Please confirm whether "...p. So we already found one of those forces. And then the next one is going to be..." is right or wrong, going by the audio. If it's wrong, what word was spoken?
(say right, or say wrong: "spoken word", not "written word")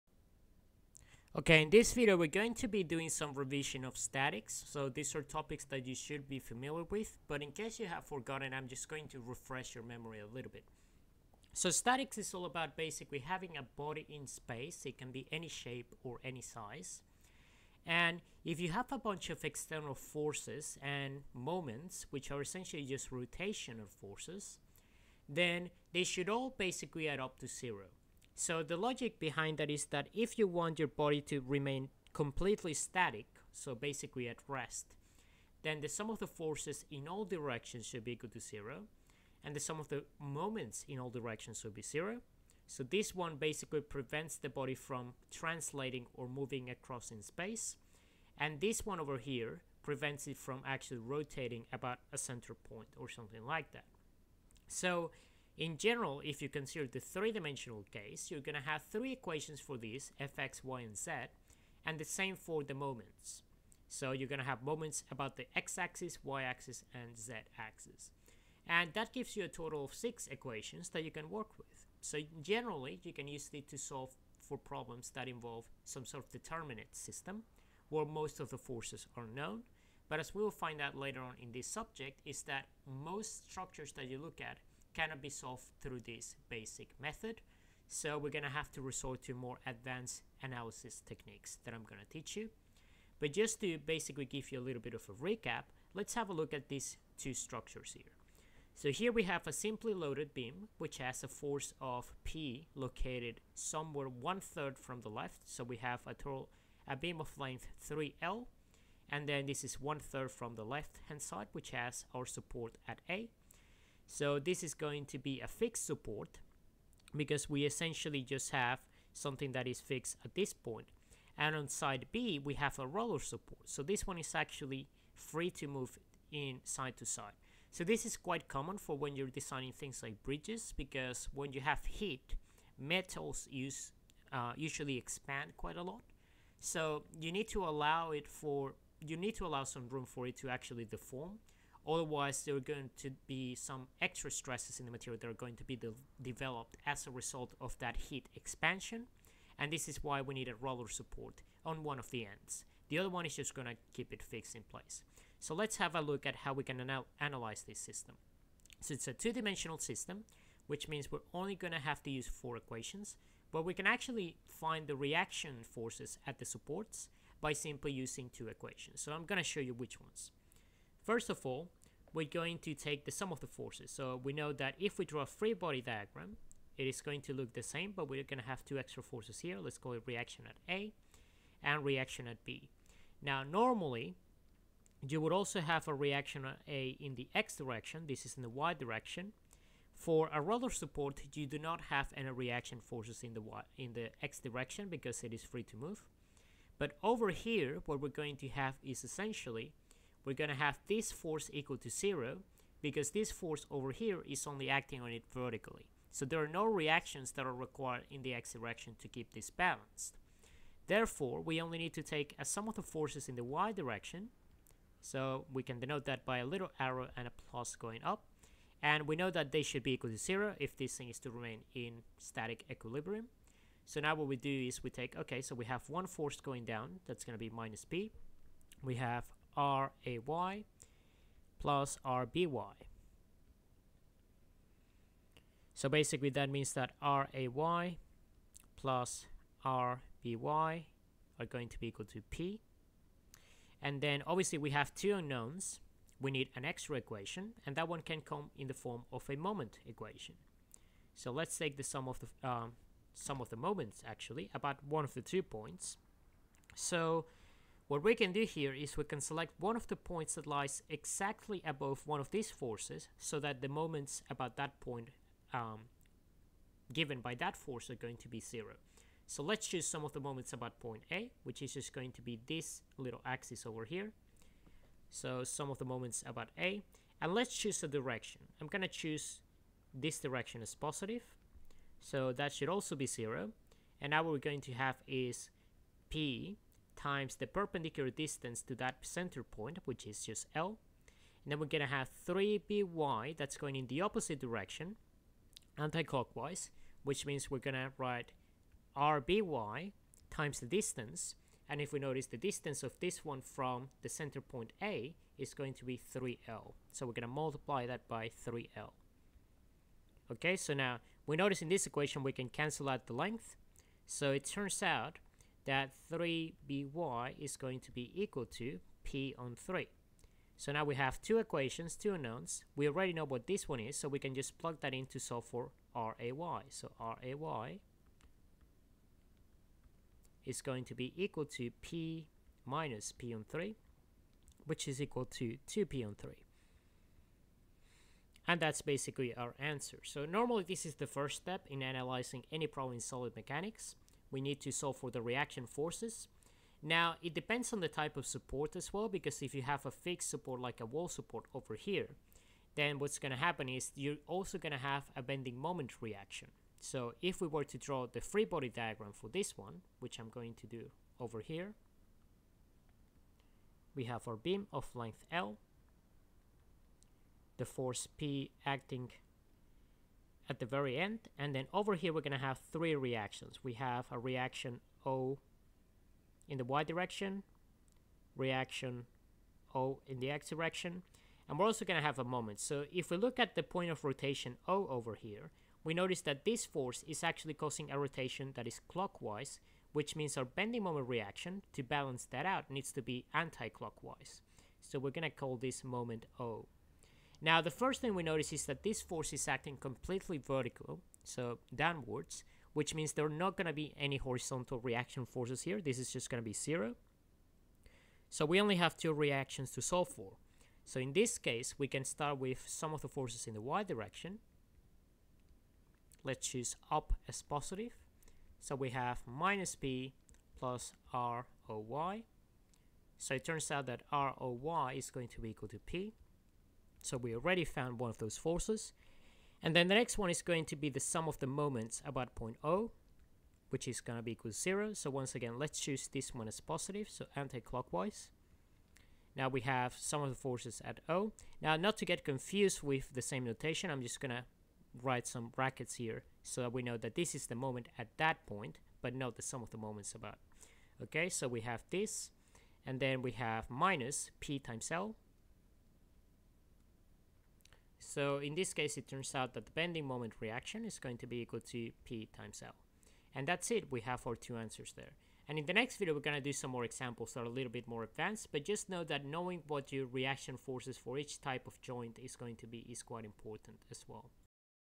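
right.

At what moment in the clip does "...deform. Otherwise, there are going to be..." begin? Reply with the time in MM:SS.
02:20.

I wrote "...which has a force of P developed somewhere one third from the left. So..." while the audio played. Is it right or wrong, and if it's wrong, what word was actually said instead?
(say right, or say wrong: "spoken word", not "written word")
wrong: "located", not "developed".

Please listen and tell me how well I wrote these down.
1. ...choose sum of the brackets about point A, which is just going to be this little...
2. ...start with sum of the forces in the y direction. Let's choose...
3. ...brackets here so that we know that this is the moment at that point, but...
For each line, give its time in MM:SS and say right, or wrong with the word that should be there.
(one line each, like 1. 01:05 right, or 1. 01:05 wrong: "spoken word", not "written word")
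1. 04:29 wrong: "moments", not "brackets"
2. 06:52 right
3. 07:25 right.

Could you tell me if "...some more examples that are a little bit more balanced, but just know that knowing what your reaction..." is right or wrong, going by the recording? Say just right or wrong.
wrong.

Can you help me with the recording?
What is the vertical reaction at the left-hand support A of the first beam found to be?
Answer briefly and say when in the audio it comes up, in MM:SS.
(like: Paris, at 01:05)
2P/3, at 05:35.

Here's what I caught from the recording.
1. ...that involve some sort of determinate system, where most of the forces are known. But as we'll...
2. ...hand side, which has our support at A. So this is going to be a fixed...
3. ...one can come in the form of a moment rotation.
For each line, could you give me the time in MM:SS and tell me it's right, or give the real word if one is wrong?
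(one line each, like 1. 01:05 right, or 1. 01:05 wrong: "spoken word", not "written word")
1. 01:15 right
2. 01:51 right
3. 04:07 wrong: "equation", not "rotation".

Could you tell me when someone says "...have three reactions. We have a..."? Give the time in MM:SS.
06:12.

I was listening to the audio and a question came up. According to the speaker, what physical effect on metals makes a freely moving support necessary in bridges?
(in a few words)
heat expansion.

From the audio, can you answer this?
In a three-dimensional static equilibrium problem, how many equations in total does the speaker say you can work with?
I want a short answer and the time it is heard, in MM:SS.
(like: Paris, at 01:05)
6, at 01:09.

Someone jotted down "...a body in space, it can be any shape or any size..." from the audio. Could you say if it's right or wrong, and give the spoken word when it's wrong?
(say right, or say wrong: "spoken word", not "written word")
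right.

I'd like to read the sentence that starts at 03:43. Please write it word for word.
So now what we do is we take, okay, so we have one force going down, that's going to be minus p.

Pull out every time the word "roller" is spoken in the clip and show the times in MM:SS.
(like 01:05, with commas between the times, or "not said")
02:02, 02:30, 03:10.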